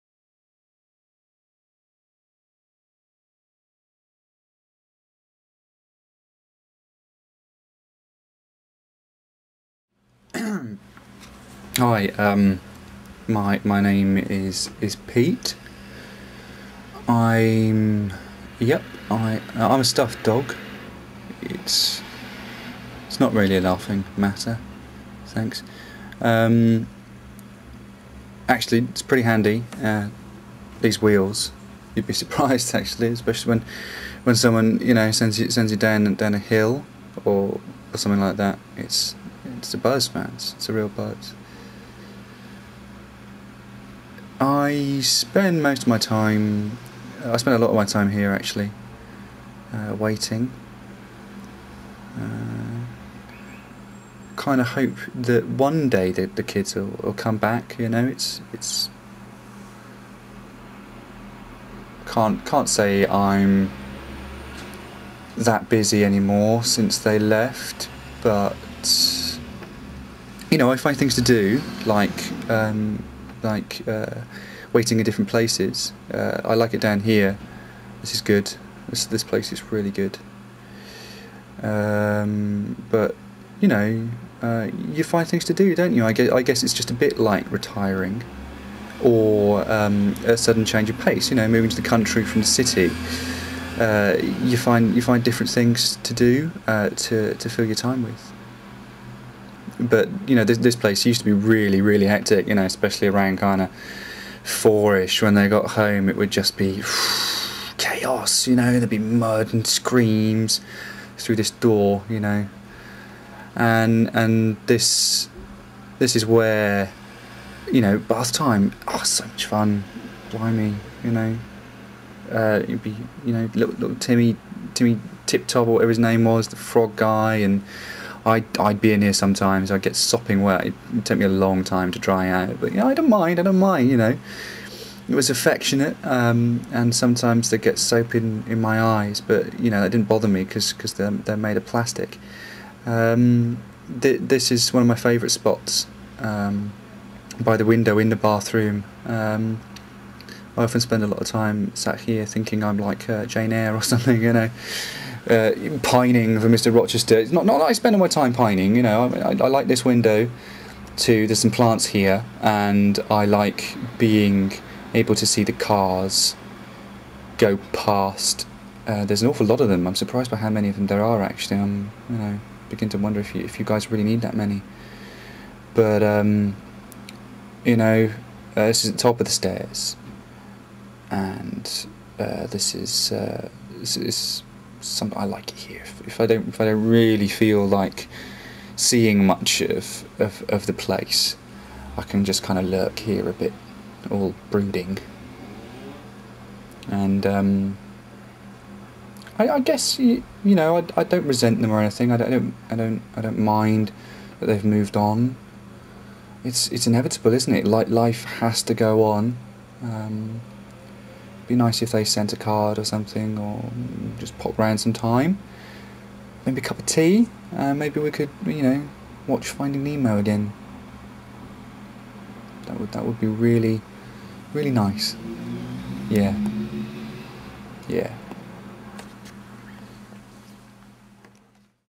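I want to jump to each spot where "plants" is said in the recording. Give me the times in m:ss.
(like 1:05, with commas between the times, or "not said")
2:41.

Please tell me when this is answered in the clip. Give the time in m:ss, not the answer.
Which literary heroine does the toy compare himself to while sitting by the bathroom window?
2:33.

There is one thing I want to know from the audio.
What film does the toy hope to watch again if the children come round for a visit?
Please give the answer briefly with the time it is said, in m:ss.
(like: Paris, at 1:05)
Finding Nemo, at 3:39.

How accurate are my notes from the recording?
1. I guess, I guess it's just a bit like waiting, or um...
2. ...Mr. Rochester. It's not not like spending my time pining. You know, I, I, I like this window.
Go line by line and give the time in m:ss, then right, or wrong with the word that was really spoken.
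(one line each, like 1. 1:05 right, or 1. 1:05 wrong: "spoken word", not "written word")
1. 1:26 wrong: "retiring", not "waiting"
2. 2:36 right.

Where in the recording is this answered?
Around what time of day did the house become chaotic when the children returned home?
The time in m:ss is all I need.
1:44.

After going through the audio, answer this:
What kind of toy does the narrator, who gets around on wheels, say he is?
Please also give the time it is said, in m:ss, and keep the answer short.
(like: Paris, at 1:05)
Stuffed dog, at 0:19.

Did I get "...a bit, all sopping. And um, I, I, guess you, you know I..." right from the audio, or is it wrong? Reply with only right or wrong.
wrong.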